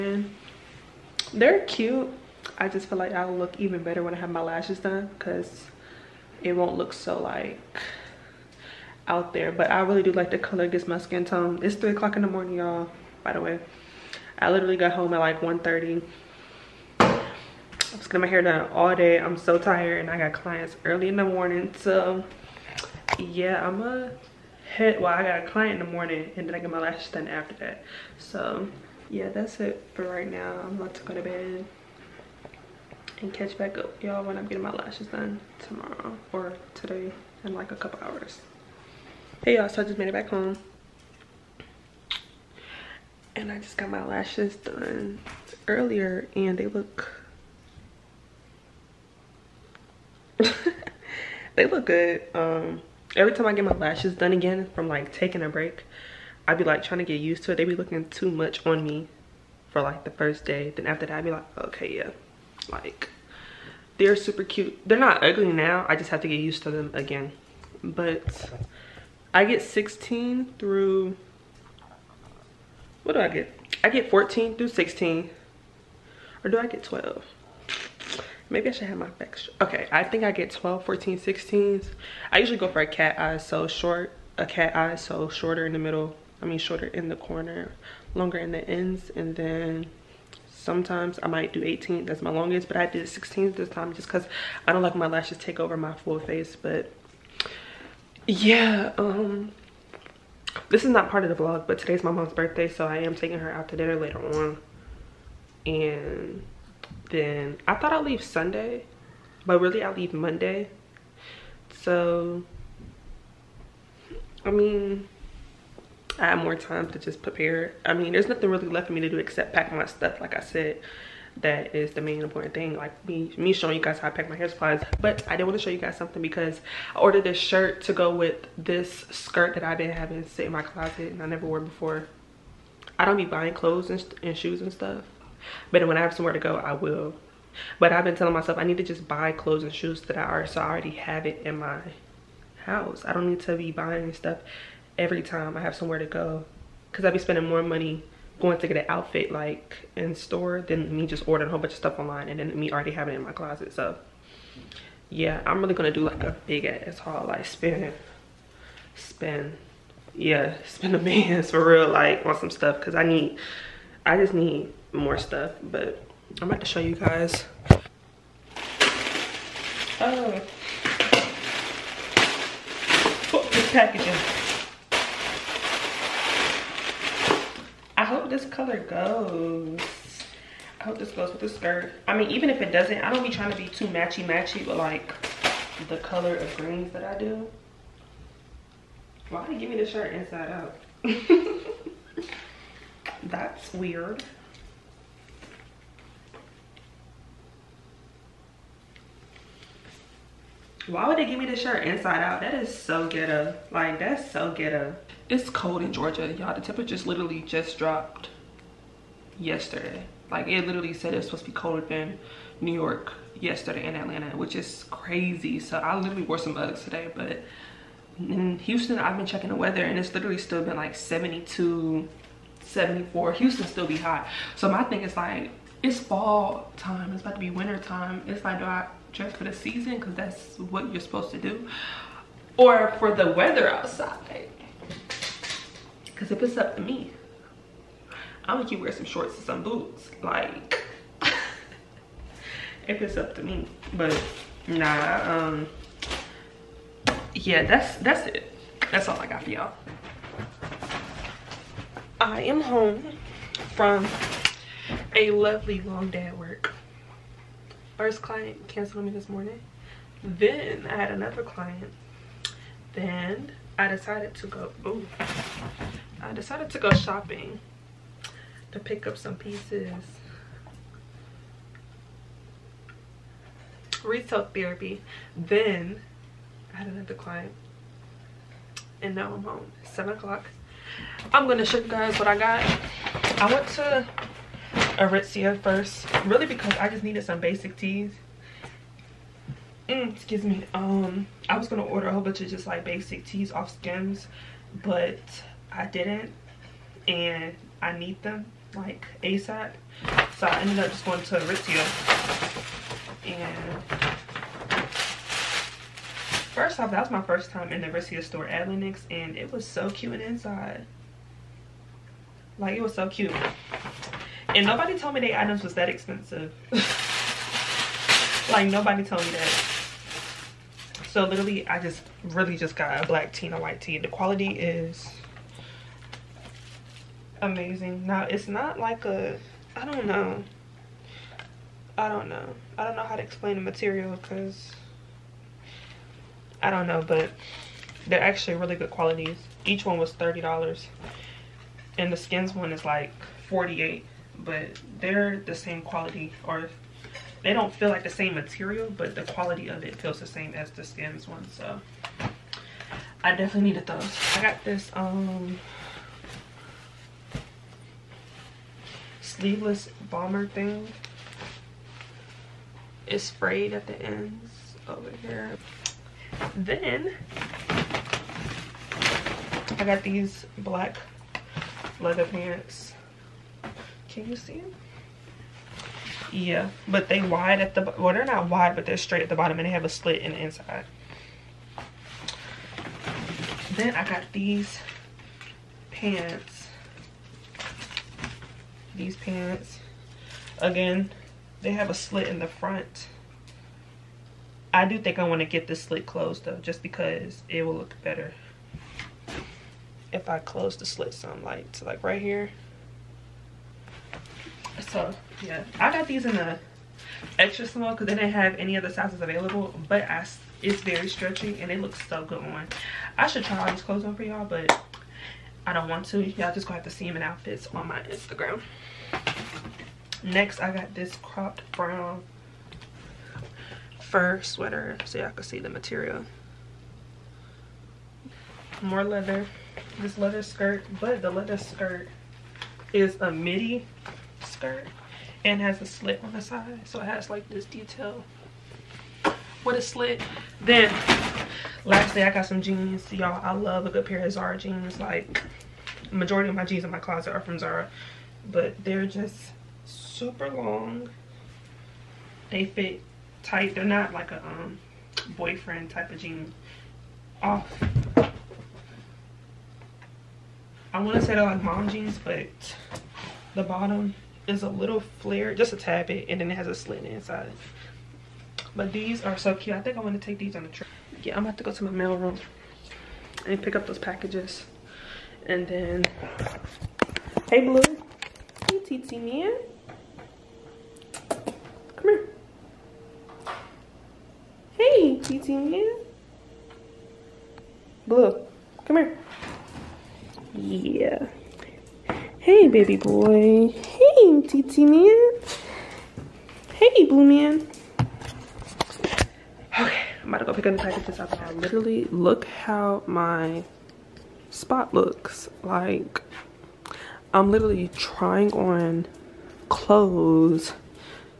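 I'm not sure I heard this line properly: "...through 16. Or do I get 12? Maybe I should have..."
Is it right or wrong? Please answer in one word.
right.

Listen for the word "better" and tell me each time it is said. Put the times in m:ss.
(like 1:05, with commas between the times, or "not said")
0:03, 6:38.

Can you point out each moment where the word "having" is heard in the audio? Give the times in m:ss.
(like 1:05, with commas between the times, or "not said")
2:09, 2:32.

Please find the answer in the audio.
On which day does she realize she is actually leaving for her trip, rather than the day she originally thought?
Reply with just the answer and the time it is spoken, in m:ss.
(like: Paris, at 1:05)
Monday, at 1:50.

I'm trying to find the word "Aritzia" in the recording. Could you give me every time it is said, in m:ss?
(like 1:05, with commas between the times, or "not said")
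4:44, 5:01, 5:07.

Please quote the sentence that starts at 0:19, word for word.
I'm so tired and I got clients early in the morning.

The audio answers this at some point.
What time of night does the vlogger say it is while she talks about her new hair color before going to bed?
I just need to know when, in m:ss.
0:11.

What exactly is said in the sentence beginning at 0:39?
Hey y'all, so I just made it back home.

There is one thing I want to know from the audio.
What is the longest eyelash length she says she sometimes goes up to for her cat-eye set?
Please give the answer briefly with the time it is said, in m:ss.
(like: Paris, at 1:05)
18, at 1:31.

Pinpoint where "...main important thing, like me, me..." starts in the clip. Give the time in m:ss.
2:02.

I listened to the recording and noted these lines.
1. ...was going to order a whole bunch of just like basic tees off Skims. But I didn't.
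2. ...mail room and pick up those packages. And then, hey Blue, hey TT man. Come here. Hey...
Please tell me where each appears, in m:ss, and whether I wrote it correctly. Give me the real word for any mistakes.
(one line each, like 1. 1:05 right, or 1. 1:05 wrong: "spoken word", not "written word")
1. 4:51 right
2. 7:51 right.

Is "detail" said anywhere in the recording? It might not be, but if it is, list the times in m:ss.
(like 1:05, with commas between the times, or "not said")
7:17.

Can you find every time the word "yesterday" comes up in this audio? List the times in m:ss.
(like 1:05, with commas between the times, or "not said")
3:29, 3:33.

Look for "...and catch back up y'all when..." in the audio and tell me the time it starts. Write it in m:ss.
0:33.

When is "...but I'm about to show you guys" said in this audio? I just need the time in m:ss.
2:45.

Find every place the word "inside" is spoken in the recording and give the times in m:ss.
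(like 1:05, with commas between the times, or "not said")
3:10, 3:21, 5:10, 6:20, 7:47.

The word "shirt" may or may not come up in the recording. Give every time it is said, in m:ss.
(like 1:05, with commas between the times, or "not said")
2:07, 3:09, 3:21.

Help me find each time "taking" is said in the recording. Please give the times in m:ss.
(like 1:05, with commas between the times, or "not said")
0:55, 1:43.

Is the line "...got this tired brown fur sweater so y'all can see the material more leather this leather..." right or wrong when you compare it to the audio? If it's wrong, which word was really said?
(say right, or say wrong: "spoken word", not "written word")
wrong: "cropped", not "tired".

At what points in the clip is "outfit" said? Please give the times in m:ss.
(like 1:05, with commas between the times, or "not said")
2:28, 6:57.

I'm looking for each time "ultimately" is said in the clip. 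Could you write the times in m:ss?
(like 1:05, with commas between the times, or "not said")
not said.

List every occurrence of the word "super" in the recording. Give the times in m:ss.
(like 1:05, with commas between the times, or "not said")
1:04, 7:29.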